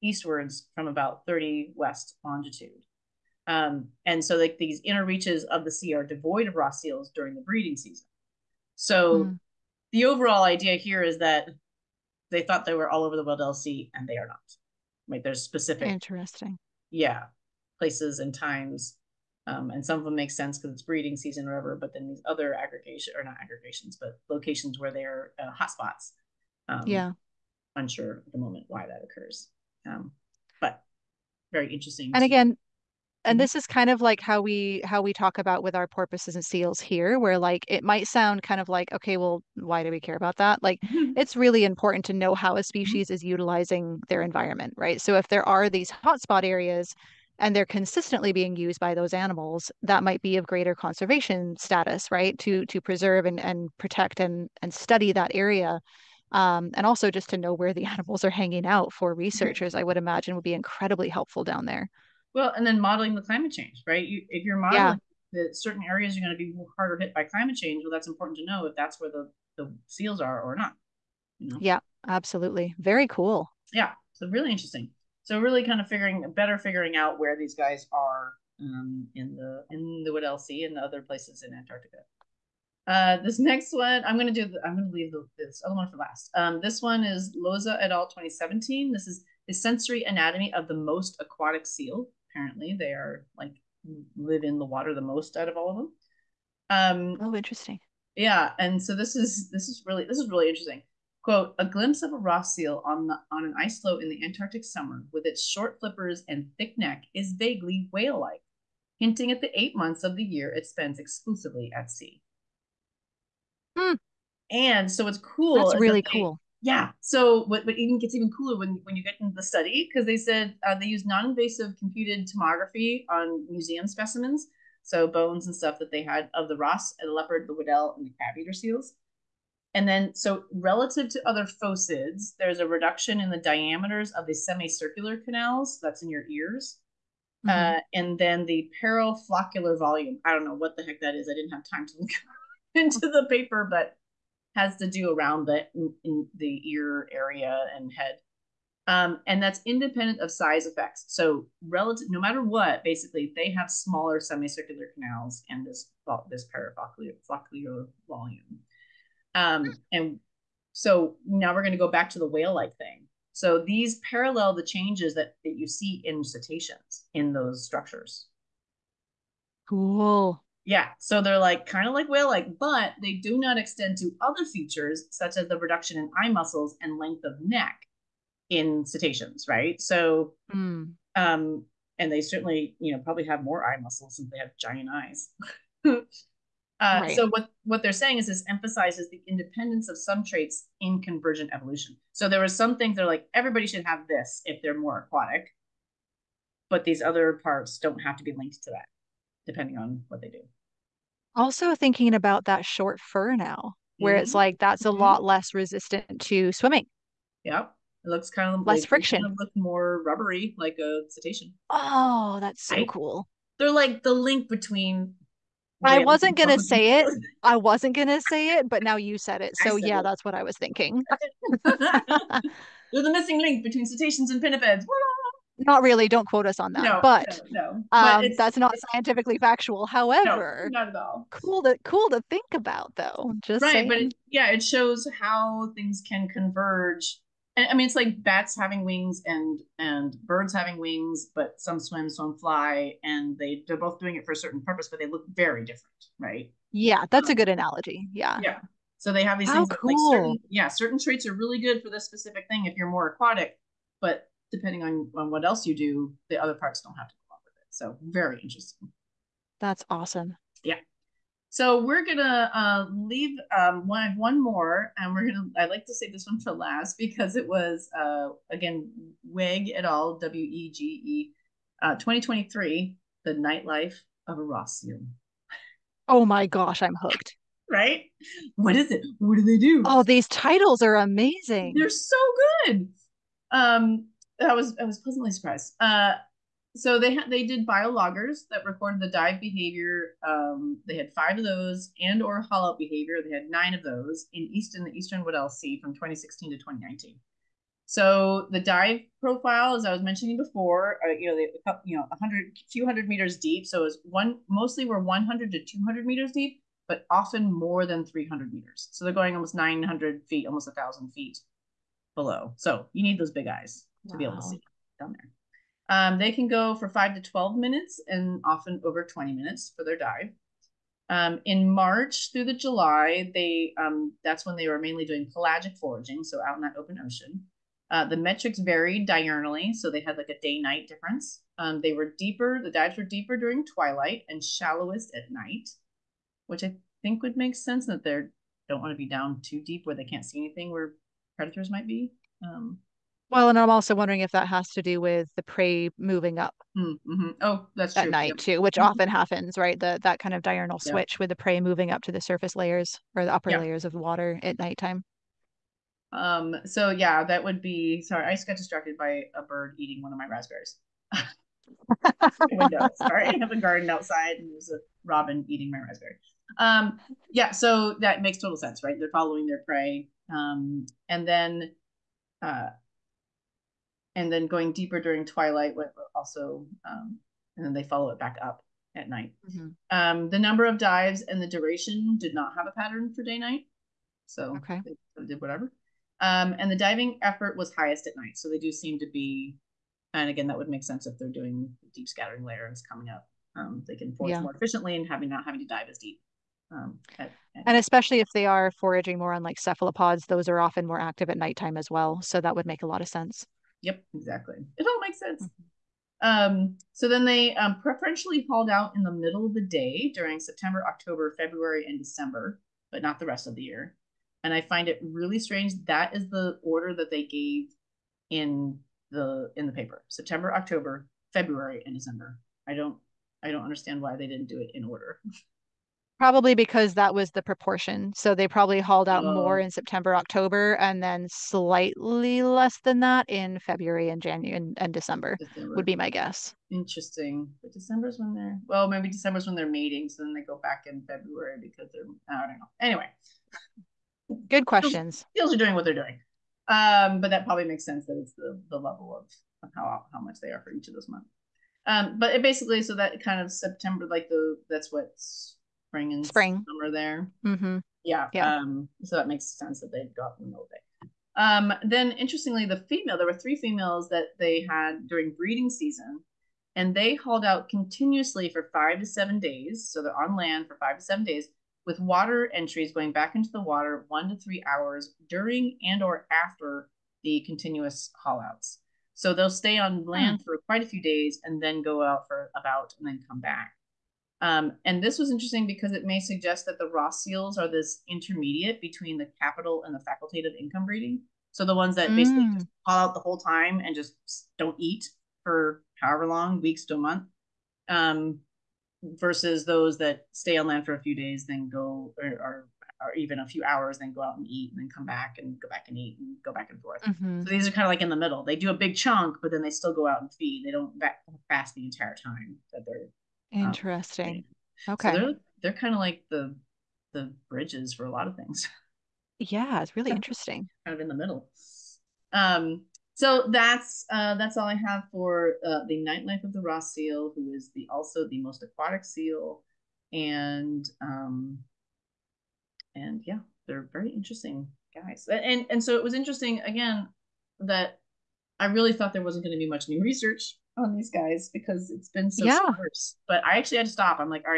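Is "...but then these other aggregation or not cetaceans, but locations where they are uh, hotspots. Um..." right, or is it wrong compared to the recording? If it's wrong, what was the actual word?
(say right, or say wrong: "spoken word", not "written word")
wrong: "aggregations", not "cetaceans".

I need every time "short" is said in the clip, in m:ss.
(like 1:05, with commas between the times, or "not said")
1:45, 3:22.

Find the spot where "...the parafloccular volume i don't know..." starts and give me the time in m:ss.
2:18.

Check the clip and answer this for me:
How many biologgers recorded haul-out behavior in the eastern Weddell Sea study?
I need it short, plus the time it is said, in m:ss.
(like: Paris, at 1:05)
9, at 4:53.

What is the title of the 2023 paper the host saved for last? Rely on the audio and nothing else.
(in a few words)
The nightlife of a Ross seal.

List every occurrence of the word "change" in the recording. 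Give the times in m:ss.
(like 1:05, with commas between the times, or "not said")
1:03, 1:07, 2:44.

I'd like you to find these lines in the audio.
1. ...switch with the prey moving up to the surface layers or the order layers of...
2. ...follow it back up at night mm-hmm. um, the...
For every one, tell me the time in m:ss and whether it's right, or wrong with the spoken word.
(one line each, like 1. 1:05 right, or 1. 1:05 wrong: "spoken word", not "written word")
1. 5:50 wrong: "upper", not "order"
2. 6:17 right.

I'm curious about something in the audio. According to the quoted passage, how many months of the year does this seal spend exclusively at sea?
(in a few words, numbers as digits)
8.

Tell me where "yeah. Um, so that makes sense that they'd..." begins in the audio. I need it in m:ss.
7:38.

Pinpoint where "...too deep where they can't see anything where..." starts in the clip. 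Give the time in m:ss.
5:39.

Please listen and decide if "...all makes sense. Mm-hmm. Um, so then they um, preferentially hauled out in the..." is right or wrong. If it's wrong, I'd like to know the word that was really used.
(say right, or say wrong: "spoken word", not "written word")
right.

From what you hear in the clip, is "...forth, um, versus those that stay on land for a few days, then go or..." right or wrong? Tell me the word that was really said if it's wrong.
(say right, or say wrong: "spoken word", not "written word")
wrong: "month", not "forth".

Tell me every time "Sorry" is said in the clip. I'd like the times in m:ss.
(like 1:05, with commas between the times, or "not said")
5:58, 6:02.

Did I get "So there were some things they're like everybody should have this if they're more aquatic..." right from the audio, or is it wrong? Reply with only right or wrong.
right.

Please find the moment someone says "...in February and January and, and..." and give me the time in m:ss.
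7:13.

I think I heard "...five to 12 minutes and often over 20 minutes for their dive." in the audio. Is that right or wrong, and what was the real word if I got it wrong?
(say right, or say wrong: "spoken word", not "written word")
right.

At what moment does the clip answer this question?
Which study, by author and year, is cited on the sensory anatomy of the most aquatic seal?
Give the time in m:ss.
1:27.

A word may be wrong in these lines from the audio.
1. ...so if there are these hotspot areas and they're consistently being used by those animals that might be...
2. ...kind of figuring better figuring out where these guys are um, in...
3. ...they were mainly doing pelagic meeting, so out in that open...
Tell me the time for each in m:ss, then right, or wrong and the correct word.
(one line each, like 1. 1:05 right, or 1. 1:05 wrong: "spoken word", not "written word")
1. 0:45 right
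2. 1:15 right
3. 5:24 wrong: "foraging", not "meeting".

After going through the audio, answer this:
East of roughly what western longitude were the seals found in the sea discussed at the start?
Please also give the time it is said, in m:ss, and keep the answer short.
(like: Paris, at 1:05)
30 west, at 0:01.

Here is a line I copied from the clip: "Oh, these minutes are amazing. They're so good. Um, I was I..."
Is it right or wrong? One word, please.
wrong.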